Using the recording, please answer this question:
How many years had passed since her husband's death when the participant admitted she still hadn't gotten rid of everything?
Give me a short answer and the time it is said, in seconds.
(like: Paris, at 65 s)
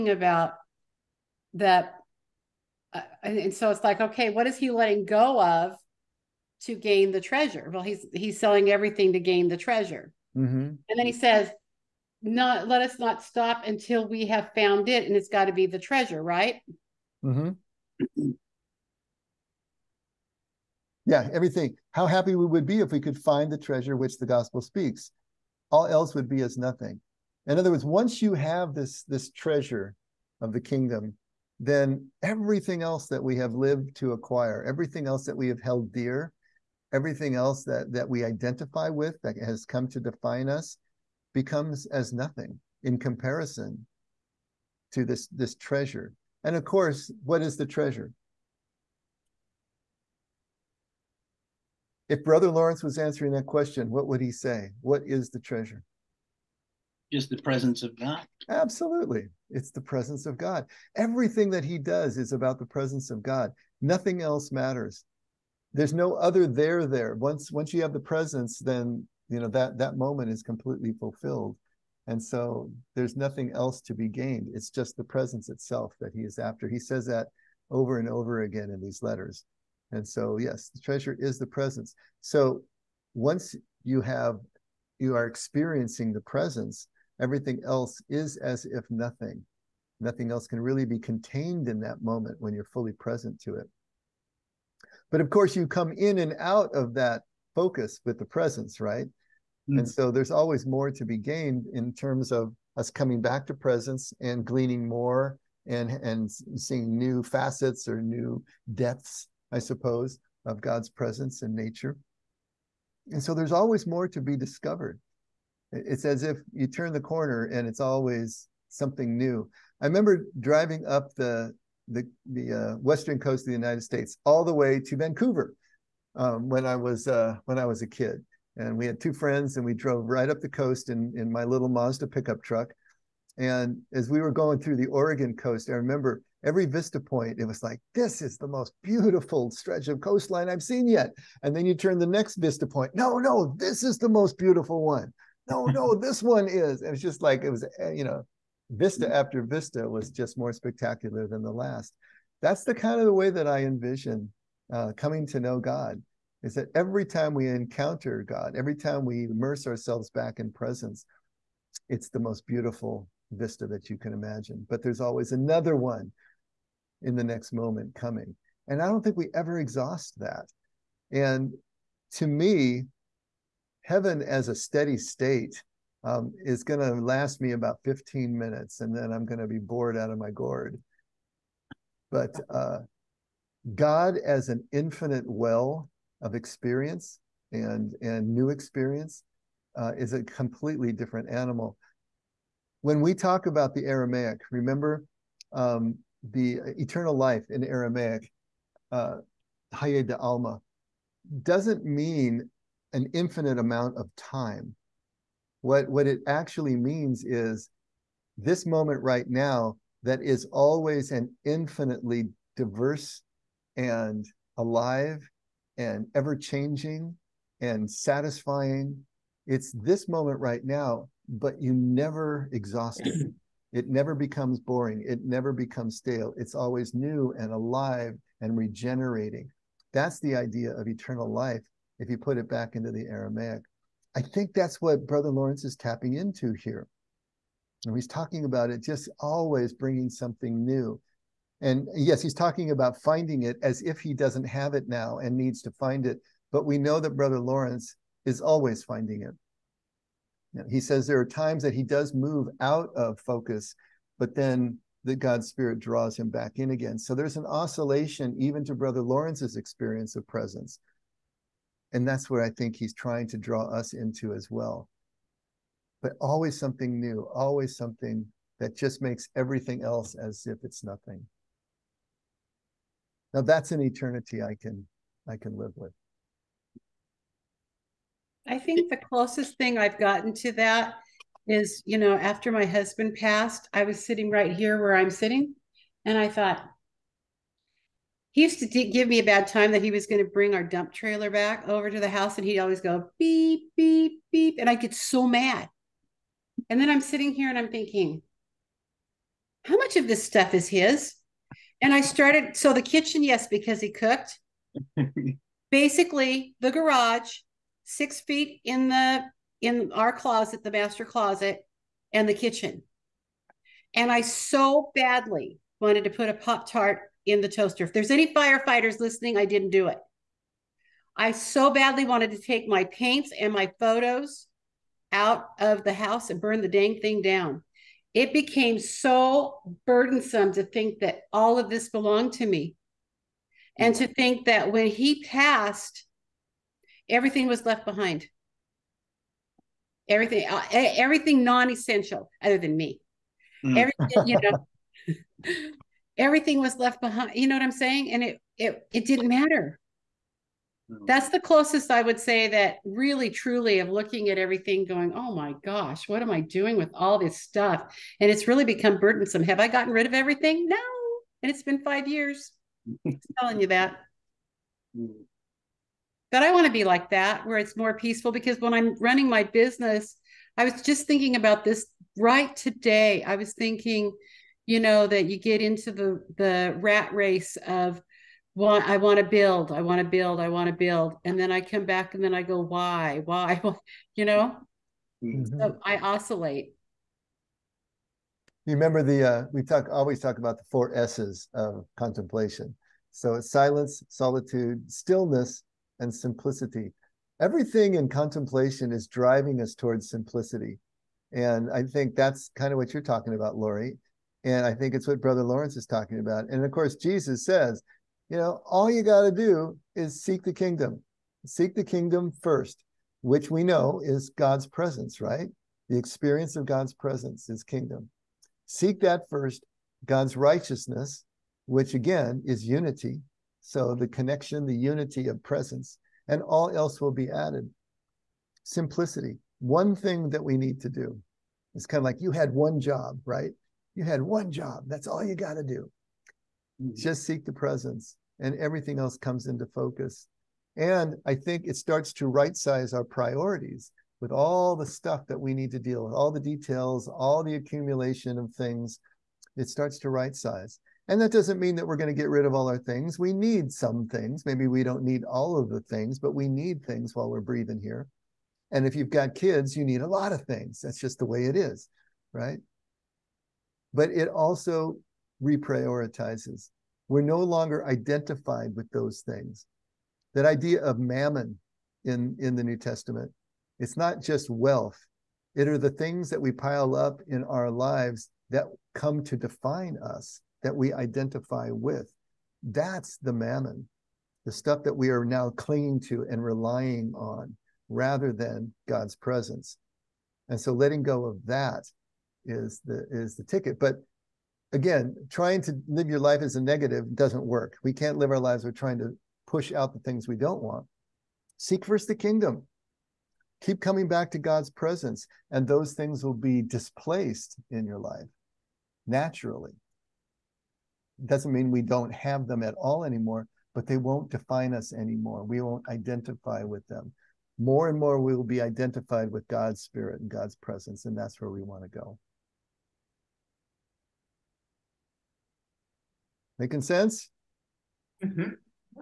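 5, at 361 s.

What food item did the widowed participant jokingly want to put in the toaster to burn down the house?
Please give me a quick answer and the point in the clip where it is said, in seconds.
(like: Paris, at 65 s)
Pop Tart, at 316 s.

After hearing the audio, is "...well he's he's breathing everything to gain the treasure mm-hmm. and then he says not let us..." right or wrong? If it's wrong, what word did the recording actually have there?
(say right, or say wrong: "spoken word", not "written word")
wrong: "selling", not "breathing".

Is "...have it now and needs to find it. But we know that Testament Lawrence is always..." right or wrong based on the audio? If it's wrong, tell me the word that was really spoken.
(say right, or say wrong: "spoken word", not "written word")
wrong: "Brother", not "Testament".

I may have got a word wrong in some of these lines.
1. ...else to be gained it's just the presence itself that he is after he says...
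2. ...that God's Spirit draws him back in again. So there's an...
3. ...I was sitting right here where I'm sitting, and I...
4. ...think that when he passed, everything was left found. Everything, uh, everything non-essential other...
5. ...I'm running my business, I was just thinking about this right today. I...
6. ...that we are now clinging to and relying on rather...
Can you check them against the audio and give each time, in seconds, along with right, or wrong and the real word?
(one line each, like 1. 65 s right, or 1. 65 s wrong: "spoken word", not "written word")
1. 73 s right
2. 255 s right
3. 283 s right
4. 334 s wrong: "behind", not "found"
5. 368 s right
6. 484 s right.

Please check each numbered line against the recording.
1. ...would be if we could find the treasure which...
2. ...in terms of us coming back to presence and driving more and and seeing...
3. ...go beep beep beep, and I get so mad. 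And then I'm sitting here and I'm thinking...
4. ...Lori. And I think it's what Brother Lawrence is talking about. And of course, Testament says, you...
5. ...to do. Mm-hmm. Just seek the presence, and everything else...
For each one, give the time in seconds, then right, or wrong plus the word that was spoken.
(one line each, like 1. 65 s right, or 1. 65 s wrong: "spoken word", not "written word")
1. 22 s right
2. 101 s wrong: "gleaning", not "driving"
3. 292 s right
4. 403 s wrong: "Jesus", not "Testament"
5. 435 s right.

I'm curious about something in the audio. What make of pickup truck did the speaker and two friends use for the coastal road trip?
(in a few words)
Mazda.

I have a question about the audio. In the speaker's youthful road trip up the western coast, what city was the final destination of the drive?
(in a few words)
Vancouver.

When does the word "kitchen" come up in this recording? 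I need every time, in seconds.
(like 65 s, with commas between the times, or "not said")
302 s, 312 s.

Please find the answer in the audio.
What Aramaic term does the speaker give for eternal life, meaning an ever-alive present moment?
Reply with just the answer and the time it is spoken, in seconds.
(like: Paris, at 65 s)
de Alma, at 199 s.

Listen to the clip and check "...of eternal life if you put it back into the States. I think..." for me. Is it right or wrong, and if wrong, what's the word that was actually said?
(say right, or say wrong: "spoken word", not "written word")
wrong: "Aramaic", not "States".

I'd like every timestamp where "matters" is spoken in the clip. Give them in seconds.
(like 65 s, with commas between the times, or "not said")
64 s, 349 s.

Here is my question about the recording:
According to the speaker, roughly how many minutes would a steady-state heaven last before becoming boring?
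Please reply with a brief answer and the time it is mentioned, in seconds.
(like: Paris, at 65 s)
15, at 177 s.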